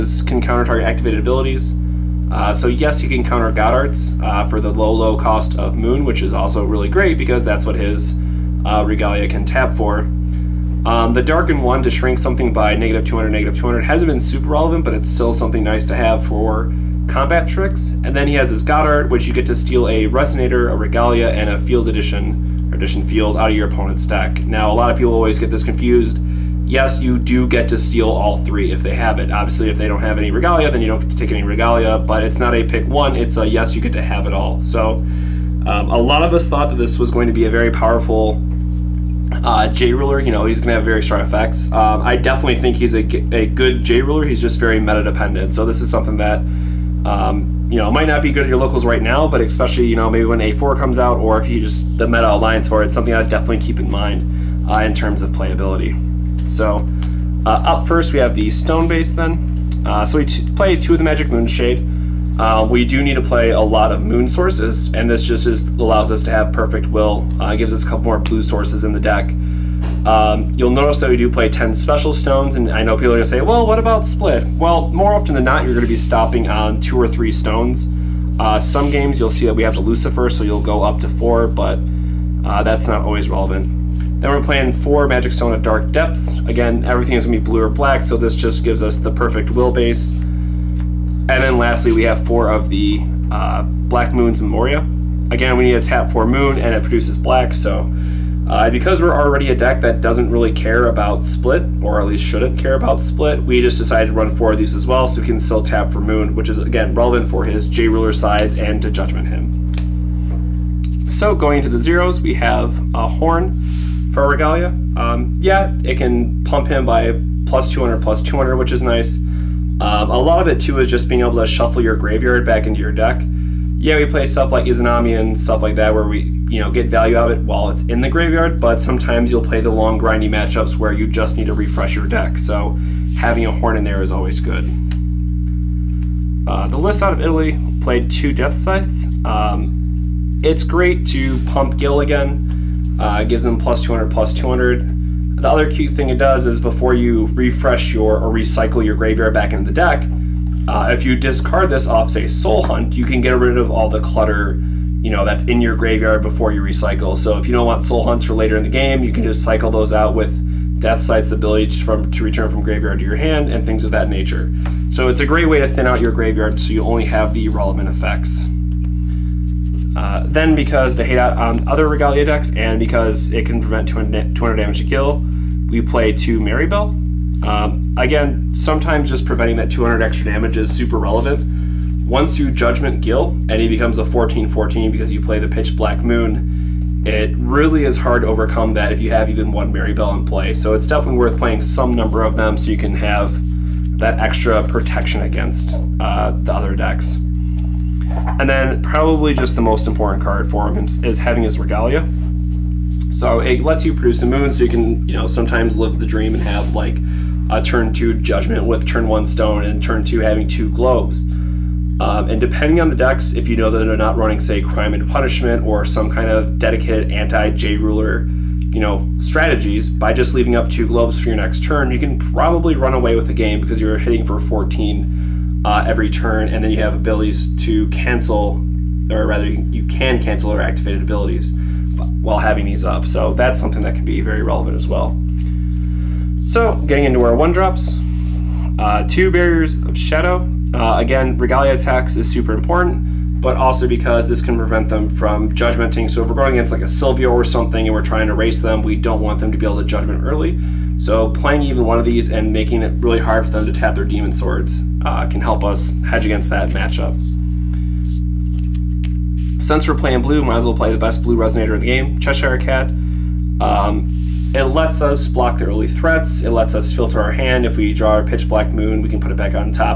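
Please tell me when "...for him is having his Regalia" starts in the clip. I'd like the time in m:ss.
3:20.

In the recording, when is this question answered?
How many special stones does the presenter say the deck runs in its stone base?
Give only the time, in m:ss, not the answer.
1:11.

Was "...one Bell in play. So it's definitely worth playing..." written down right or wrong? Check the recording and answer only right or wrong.
right.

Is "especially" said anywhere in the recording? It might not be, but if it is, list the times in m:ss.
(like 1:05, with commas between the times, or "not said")
0:49.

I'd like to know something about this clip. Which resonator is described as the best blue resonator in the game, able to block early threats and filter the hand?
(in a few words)
Cheshire Cat.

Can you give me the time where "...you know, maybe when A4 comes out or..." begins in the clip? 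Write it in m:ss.
0:49.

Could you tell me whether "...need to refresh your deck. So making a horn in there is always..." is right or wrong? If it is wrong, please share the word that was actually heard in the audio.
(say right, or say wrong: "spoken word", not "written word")
wrong: "having", not "making".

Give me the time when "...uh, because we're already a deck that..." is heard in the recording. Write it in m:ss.
1:38.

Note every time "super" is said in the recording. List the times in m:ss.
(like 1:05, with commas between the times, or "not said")
0:14, 3:00, 4:02.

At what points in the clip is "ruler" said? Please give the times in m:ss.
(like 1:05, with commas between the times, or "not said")
0:39, 0:44, 1:47, 3:37.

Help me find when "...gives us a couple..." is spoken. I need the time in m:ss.
1:07.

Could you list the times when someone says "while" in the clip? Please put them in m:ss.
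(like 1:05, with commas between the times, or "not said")
2:07, 3:52.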